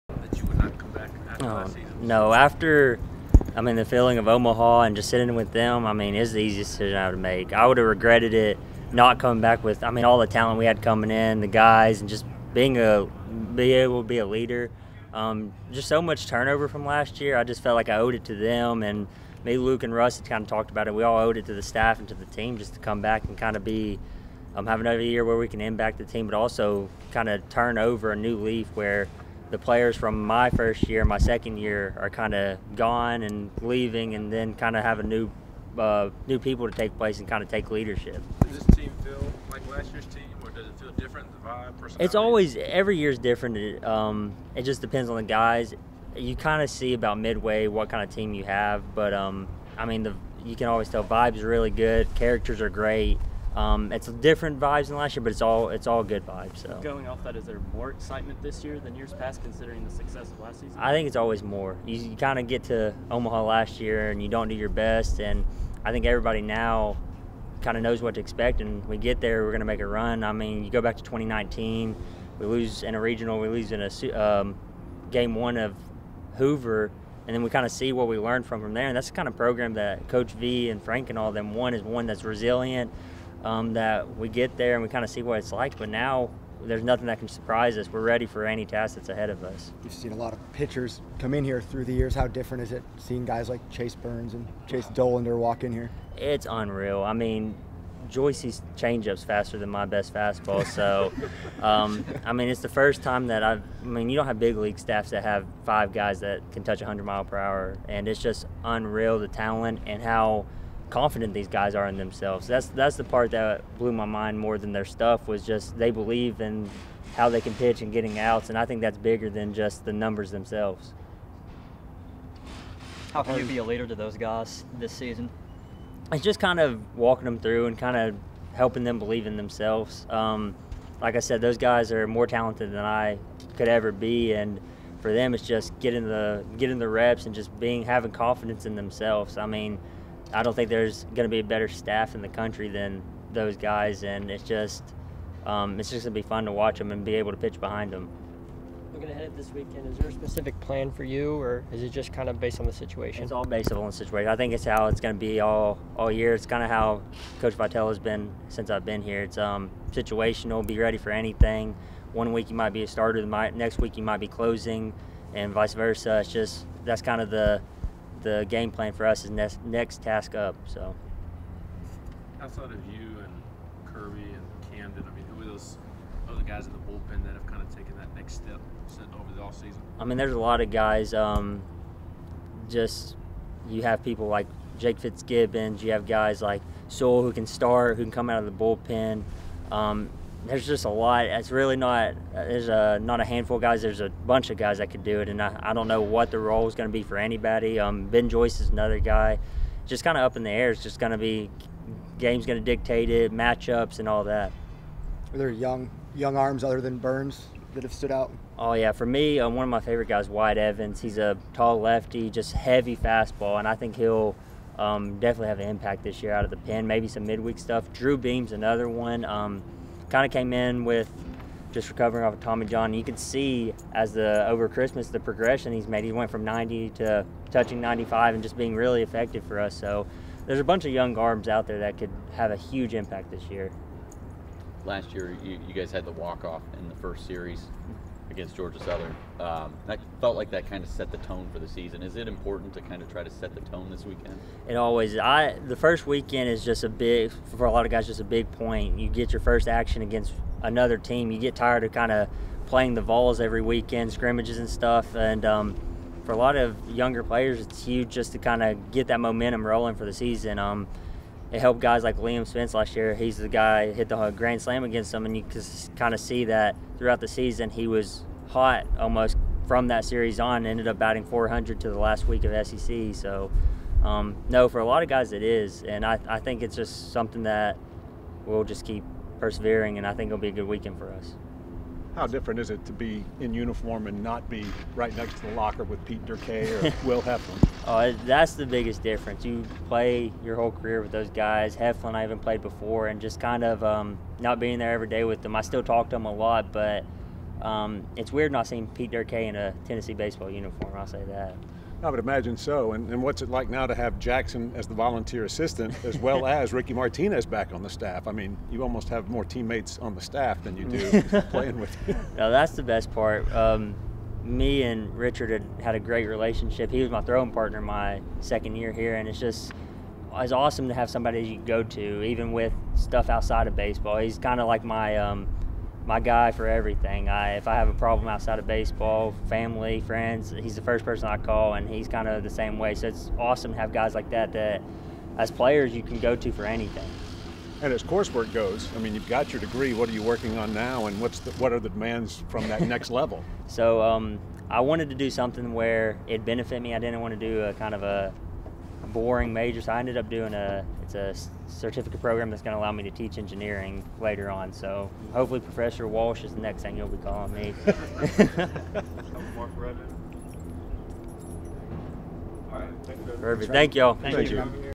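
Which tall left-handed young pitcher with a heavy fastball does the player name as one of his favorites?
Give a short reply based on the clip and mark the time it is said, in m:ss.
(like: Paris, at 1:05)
White Evans, at 3:30.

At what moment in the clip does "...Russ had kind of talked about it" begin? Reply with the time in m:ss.
0:19.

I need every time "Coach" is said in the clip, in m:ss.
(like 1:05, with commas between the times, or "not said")
1:20, 2:37.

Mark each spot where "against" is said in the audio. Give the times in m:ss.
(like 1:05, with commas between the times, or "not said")
3:58, 4:10, 4:24.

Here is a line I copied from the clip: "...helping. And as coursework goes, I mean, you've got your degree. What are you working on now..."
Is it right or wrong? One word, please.
wrong.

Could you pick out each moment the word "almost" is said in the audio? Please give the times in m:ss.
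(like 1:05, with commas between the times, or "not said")
4:28, 5:08.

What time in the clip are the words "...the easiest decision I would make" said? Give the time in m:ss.
0:06.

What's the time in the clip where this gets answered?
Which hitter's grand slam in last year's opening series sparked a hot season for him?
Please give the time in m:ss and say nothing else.
4:22.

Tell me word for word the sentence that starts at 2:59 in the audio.
I mean, there's a lot of guys.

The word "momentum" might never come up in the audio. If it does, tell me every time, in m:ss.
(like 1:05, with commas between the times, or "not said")
4:19.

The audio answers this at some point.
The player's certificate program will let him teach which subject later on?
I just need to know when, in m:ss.
5:53.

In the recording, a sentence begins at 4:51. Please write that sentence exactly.
Heflin, I even played before, and just kind of um, not being there every day with them.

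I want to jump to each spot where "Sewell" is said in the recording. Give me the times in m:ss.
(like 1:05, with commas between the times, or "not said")
3:06.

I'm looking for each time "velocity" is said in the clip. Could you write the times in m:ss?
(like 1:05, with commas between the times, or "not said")
not said.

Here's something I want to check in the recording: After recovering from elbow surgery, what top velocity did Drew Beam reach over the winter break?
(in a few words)
95.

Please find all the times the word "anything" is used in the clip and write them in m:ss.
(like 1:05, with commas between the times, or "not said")
2:41, 5:36.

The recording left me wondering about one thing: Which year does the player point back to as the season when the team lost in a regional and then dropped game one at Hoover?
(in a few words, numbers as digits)
2019.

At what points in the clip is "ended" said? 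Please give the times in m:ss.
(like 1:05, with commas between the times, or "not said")
4:30, 5:49.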